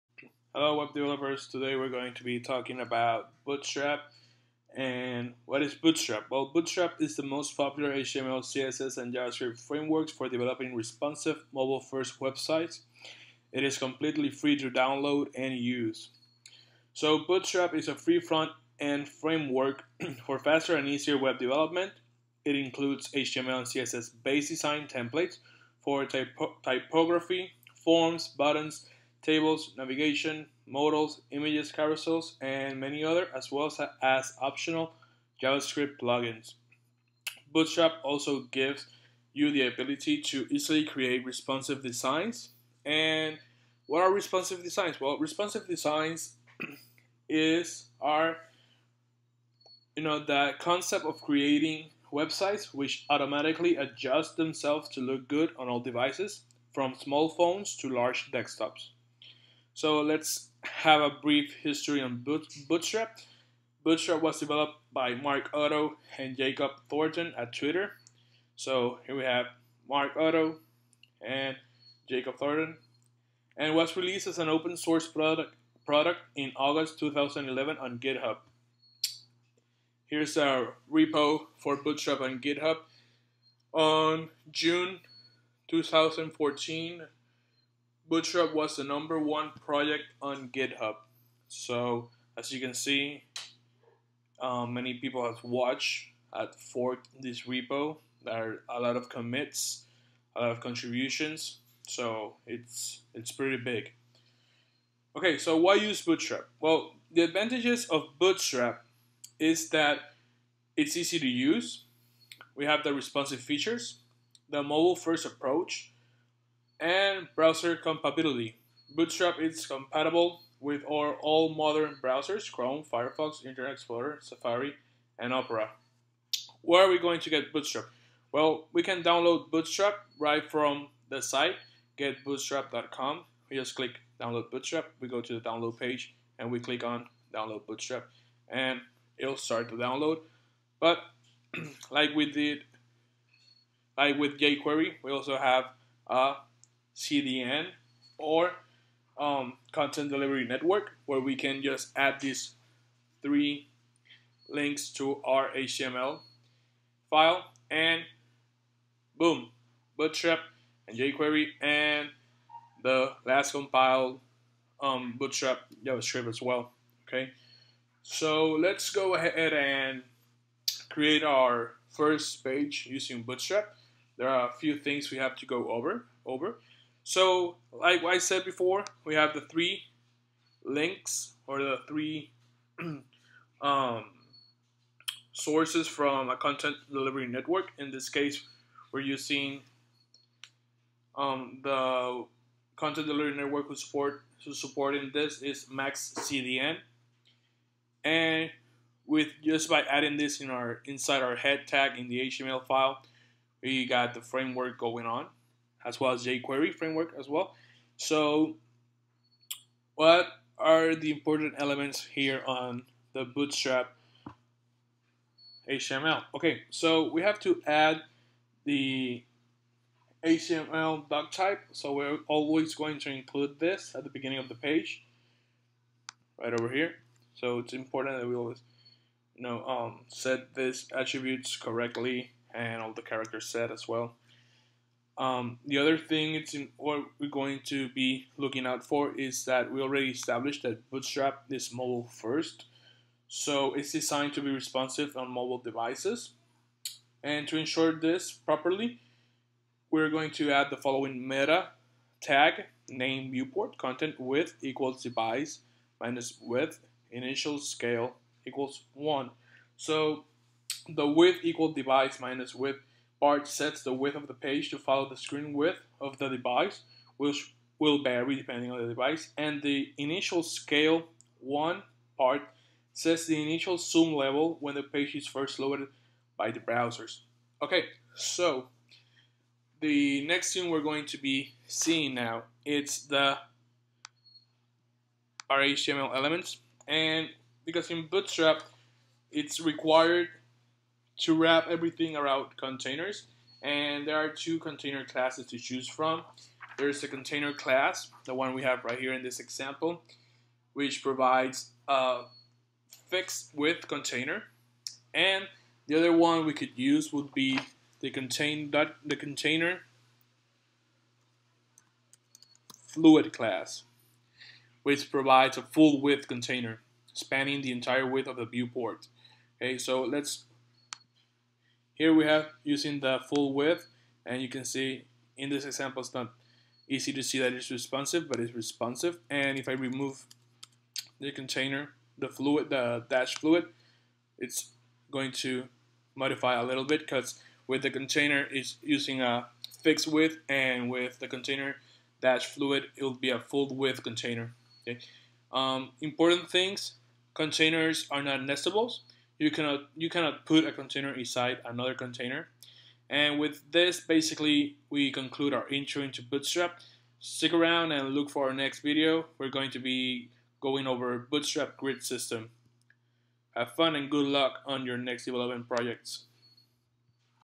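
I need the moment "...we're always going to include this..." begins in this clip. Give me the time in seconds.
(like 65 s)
221 s.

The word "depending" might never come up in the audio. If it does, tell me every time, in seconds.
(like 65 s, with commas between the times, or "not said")
268 s.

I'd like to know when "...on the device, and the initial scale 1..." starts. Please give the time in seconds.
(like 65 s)
268 s.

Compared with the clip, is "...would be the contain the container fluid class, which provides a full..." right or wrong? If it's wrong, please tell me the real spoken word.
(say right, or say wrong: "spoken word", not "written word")
right.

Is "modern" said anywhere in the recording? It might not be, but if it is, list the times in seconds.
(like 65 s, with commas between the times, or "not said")
121 s.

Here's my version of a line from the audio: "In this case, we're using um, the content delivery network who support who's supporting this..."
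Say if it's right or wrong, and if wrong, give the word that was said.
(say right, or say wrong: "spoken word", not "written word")
right.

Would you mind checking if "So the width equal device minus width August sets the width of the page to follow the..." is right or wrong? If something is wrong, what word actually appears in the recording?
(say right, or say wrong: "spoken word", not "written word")
wrong: "Bart", not "August".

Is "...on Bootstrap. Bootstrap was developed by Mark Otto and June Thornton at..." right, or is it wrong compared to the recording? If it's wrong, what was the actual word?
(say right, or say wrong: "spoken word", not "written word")
wrong: "Jacob", not "June".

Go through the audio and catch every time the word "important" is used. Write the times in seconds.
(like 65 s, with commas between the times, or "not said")
211 s, 227 s, 346 s.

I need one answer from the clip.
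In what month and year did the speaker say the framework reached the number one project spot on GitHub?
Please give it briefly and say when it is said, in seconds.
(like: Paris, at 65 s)
June 2014, at 84 s.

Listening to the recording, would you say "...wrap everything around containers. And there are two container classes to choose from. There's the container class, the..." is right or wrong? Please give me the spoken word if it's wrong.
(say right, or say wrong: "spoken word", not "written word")
right.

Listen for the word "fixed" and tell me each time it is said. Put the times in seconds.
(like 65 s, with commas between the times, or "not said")
303 s, 339 s.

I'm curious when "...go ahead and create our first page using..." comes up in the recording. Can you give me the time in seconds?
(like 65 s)
168 s.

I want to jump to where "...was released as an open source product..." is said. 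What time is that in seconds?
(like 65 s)
73 s.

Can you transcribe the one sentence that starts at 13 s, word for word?
It is completely free to download and use.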